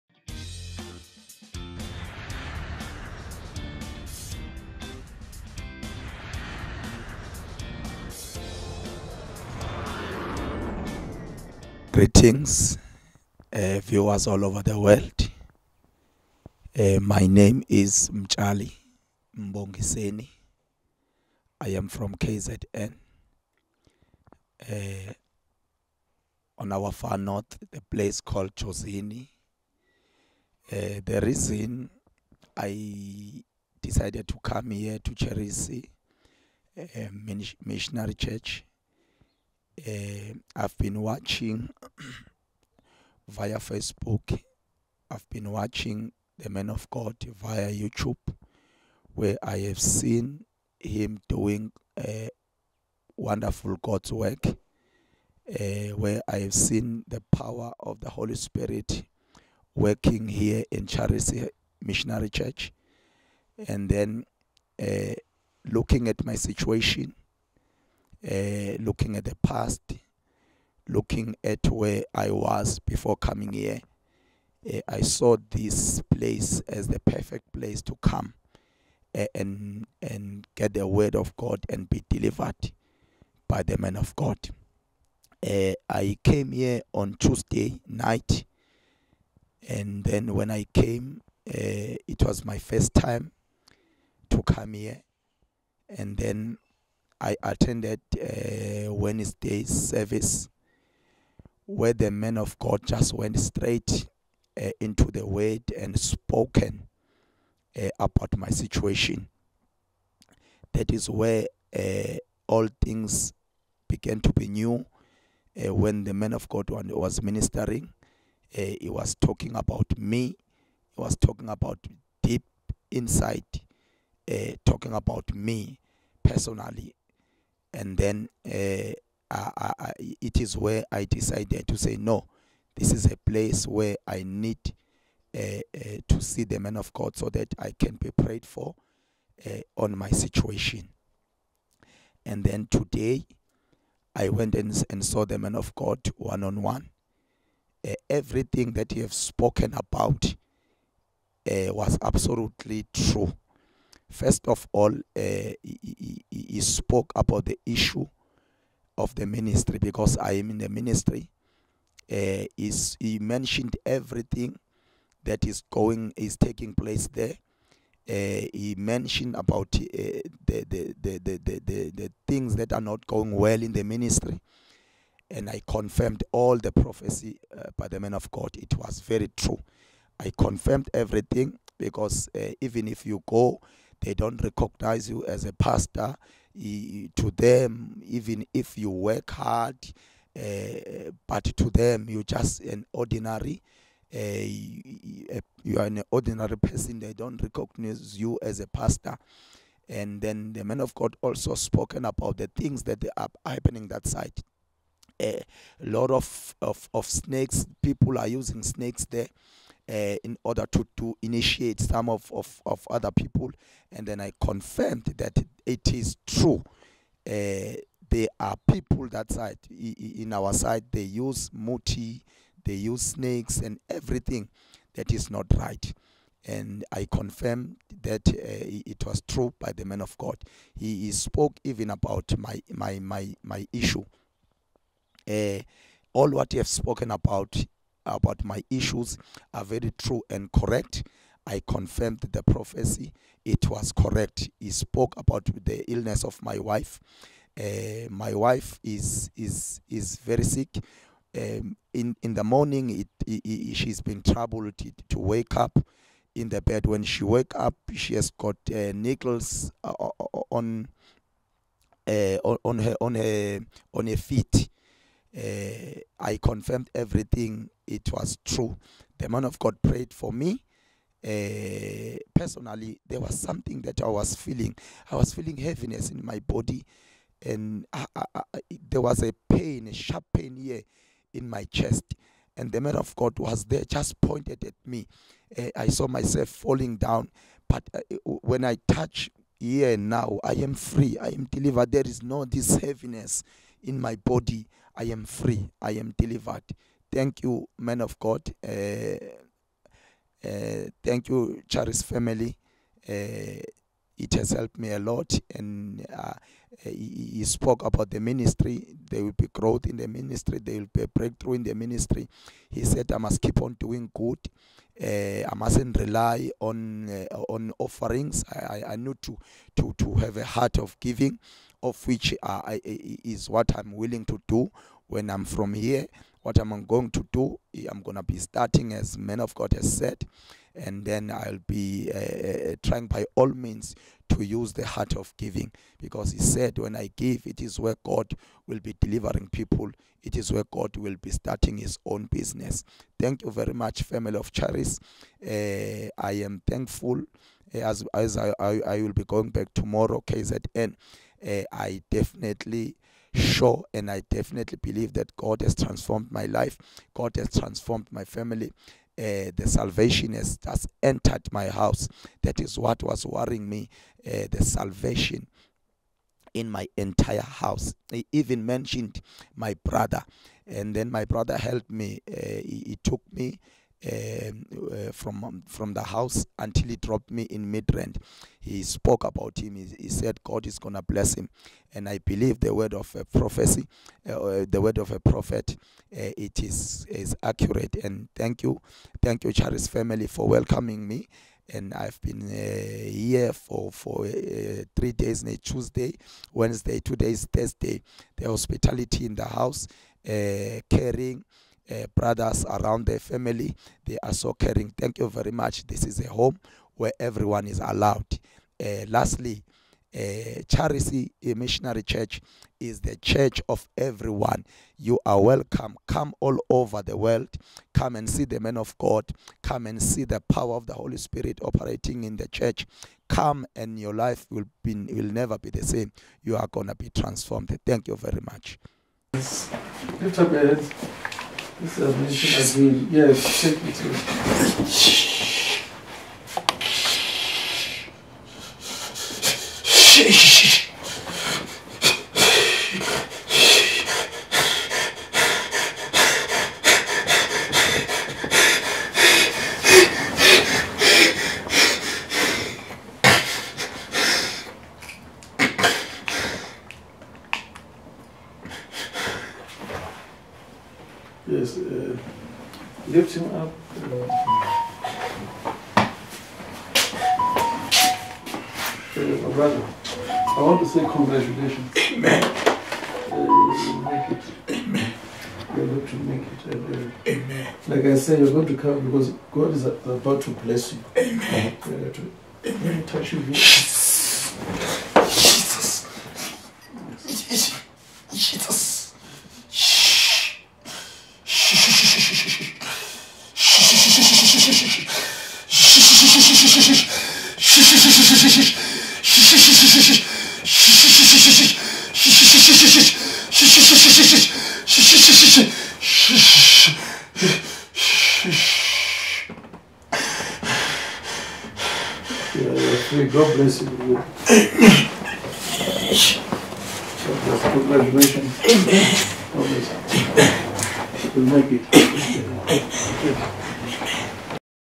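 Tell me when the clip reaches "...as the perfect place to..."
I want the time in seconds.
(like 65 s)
76 s.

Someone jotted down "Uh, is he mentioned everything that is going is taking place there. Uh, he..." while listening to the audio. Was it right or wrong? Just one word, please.
right.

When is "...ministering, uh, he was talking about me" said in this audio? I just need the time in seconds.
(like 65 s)
117 s.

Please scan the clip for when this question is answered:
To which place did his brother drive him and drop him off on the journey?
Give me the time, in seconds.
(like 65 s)
377 s.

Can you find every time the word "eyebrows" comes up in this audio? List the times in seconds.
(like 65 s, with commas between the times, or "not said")
not said.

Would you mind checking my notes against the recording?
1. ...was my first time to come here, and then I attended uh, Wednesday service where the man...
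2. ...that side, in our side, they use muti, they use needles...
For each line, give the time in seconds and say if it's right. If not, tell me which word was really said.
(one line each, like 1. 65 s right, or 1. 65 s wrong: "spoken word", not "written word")
1. 92 s right
2. 219 s wrong: "snakes", not "needles".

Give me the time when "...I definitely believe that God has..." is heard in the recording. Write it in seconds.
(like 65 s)
354 s.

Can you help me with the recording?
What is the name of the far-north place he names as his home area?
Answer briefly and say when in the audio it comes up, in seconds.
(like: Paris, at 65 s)
Chosini, at 28 s.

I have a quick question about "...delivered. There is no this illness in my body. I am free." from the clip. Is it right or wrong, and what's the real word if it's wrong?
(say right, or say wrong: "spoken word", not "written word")
wrong: "heaviness", not "illness".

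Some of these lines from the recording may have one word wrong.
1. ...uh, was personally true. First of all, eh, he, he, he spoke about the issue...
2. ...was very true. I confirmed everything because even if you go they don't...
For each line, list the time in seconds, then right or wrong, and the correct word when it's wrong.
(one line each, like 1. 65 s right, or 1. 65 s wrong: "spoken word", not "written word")
1. 151 s wrong: "absolutely", not "personally"
2. 178 s right.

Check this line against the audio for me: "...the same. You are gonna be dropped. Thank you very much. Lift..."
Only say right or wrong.
wrong.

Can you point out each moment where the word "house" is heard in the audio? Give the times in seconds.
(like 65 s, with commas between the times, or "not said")
361 s, 367 s, 376 s, 399 s.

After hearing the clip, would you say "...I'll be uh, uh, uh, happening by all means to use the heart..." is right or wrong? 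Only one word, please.
wrong.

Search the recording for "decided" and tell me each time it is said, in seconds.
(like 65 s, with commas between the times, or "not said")
33 s, 131 s.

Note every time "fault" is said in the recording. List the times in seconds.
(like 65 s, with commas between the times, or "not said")
not said.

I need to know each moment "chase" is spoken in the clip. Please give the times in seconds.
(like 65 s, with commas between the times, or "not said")
not said.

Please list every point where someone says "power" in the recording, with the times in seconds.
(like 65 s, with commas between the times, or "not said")
57 s, 420 s.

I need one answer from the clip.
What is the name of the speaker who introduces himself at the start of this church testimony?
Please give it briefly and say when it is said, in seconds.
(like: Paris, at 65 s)
Mchali Mbongiseni, at 18 s.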